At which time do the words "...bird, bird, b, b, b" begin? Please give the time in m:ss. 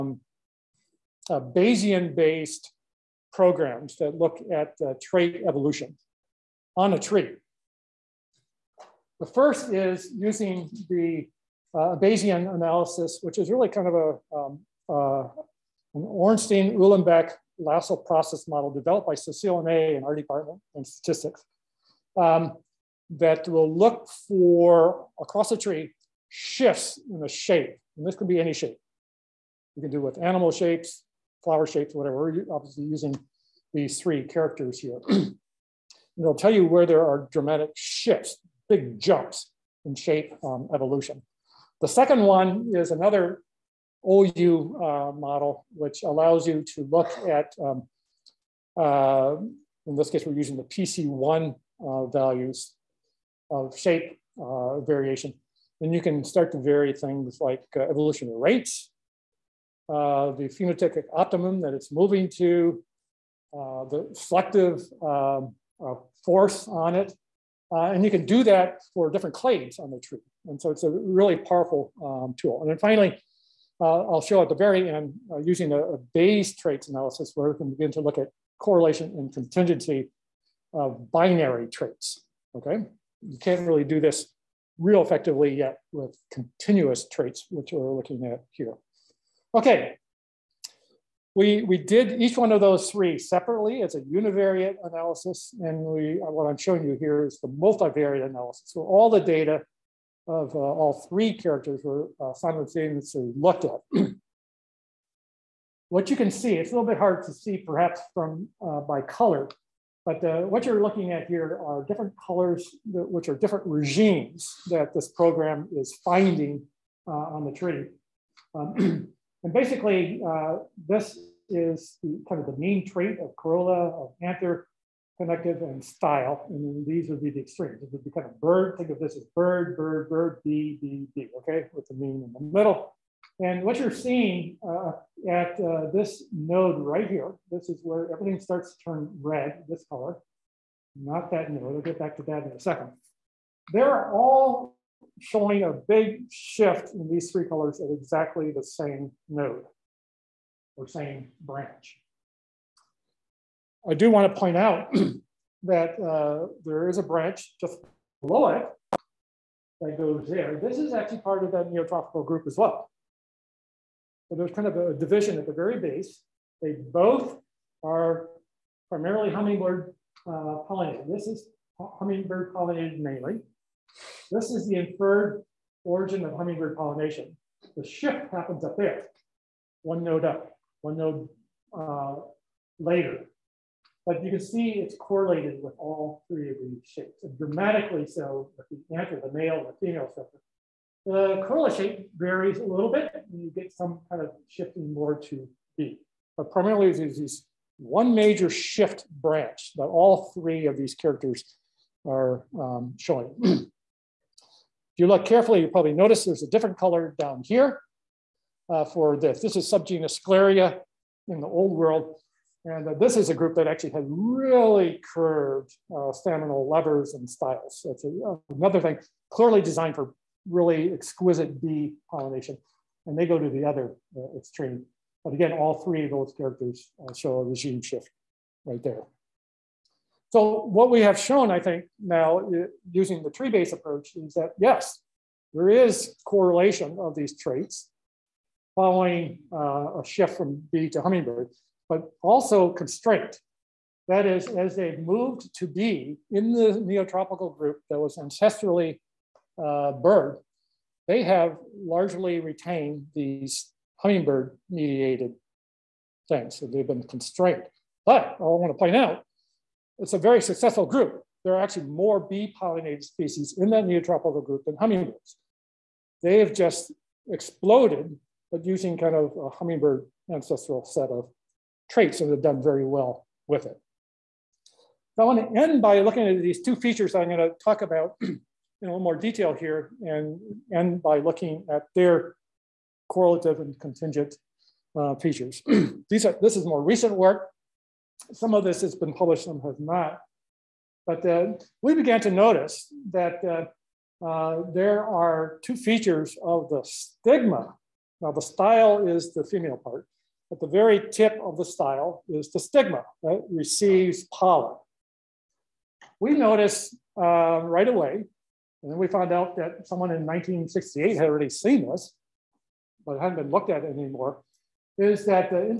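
2:09.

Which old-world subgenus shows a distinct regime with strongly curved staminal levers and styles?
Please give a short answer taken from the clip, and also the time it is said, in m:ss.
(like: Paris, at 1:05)
Scleria, at 3:30.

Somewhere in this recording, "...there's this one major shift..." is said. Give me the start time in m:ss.
3:16.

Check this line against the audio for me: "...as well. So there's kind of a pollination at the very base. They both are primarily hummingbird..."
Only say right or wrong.
wrong.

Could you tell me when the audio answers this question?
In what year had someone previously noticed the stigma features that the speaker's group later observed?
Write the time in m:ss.
5:10.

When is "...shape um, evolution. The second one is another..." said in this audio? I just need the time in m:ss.
0:39.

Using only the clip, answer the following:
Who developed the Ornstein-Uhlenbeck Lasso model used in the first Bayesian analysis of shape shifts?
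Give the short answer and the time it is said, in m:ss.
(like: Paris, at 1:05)
Cecile May, at 0:19.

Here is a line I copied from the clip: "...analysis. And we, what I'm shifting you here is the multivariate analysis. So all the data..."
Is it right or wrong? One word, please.
wrong.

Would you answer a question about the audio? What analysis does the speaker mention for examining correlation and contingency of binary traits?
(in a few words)
Bayes traits analysis.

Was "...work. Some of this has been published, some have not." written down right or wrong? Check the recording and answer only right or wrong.
right.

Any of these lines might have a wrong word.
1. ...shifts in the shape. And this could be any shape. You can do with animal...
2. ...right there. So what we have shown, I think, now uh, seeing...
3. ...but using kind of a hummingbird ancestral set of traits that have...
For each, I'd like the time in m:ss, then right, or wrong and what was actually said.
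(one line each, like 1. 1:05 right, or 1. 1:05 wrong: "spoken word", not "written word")
1. 0:26 right
2. 3:48 wrong: "using", not "seeing"
3. 4:28 right.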